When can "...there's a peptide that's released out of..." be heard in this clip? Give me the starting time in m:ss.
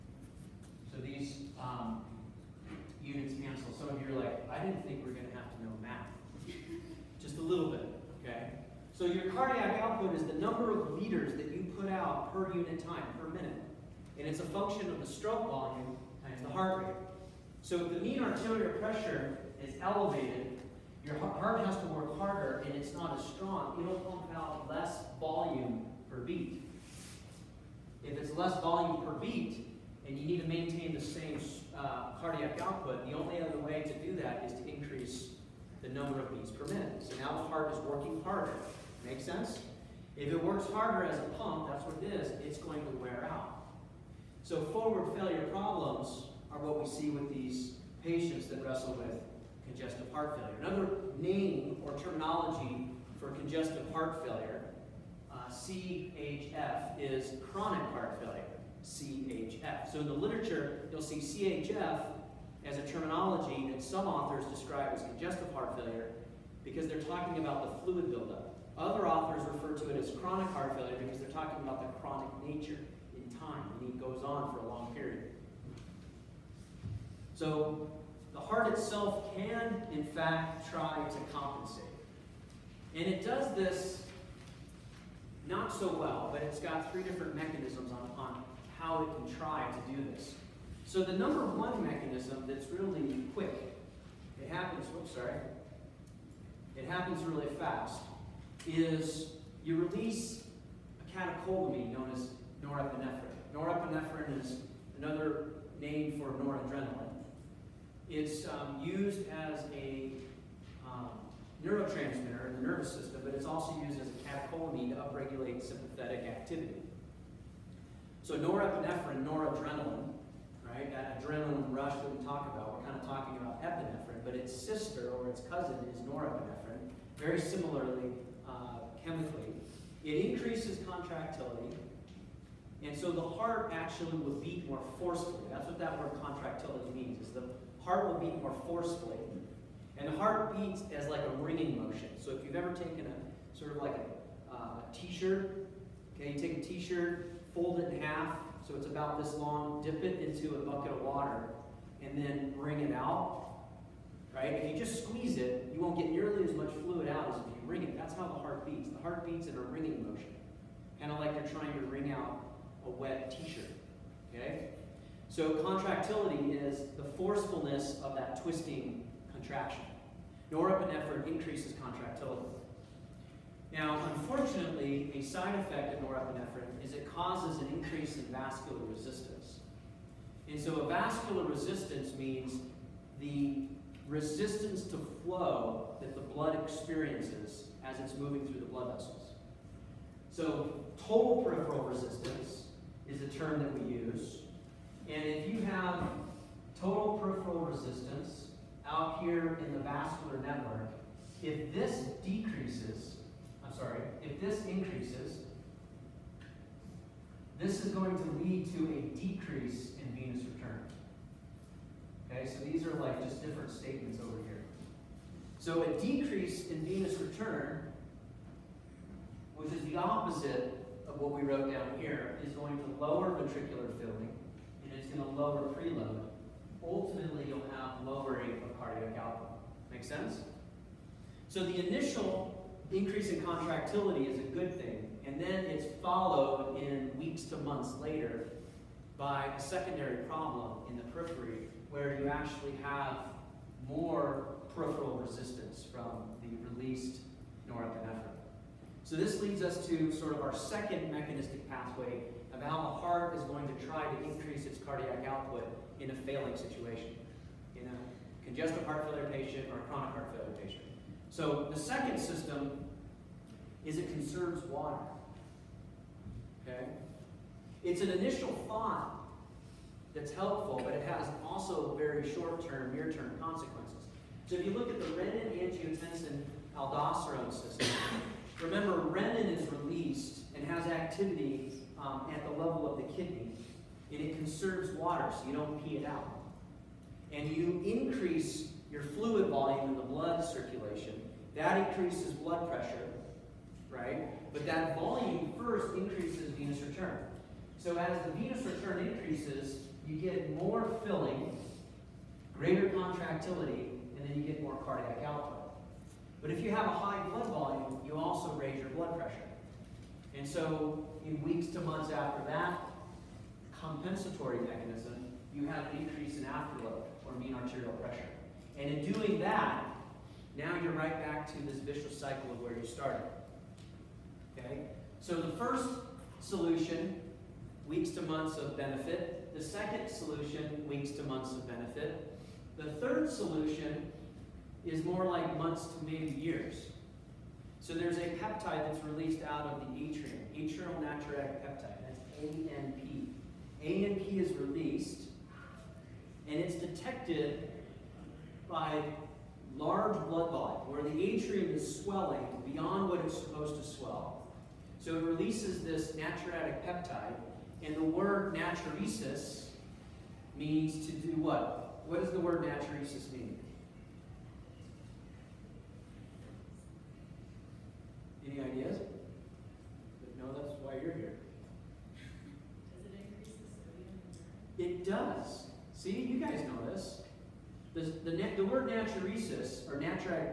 5:37.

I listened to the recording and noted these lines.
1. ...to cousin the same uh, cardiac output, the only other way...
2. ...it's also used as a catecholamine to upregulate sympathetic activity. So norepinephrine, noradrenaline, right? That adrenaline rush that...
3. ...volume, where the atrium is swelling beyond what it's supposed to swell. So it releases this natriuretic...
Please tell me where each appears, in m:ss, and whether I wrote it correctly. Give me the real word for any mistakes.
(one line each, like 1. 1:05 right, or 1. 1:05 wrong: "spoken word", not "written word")
1. 0:30 wrong: "maintain", not "cousin"
2. 1:53 right
3. 5:50 right.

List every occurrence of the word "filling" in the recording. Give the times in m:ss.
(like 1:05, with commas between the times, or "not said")
3:43, 5:01.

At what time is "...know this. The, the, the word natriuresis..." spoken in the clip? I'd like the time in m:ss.
6:16.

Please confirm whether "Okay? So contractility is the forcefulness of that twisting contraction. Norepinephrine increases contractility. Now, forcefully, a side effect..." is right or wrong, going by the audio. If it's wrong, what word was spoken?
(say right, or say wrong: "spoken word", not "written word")
wrong: "unfortunately", not "forcefully".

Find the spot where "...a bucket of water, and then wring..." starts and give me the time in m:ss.
2:30.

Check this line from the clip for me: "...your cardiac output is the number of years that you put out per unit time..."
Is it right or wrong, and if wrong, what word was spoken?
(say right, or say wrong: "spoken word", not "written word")
wrong: "liters", not "years".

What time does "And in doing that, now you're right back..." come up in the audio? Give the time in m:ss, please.
5:18.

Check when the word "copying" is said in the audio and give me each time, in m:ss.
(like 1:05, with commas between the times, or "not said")
not said.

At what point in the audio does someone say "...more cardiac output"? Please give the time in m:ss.
5:04.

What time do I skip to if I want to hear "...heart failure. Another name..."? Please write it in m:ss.
0:50.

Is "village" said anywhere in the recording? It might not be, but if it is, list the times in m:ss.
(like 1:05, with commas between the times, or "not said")
not said.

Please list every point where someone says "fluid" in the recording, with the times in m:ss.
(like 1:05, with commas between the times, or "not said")
1:07, 2:36, 4:49.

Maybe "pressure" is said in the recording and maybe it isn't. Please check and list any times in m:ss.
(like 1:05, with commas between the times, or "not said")
0:18, 4:52, 5:09, 5:17.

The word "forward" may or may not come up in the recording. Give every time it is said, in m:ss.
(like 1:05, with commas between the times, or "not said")
0:44.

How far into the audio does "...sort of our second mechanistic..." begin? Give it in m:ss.
4:10.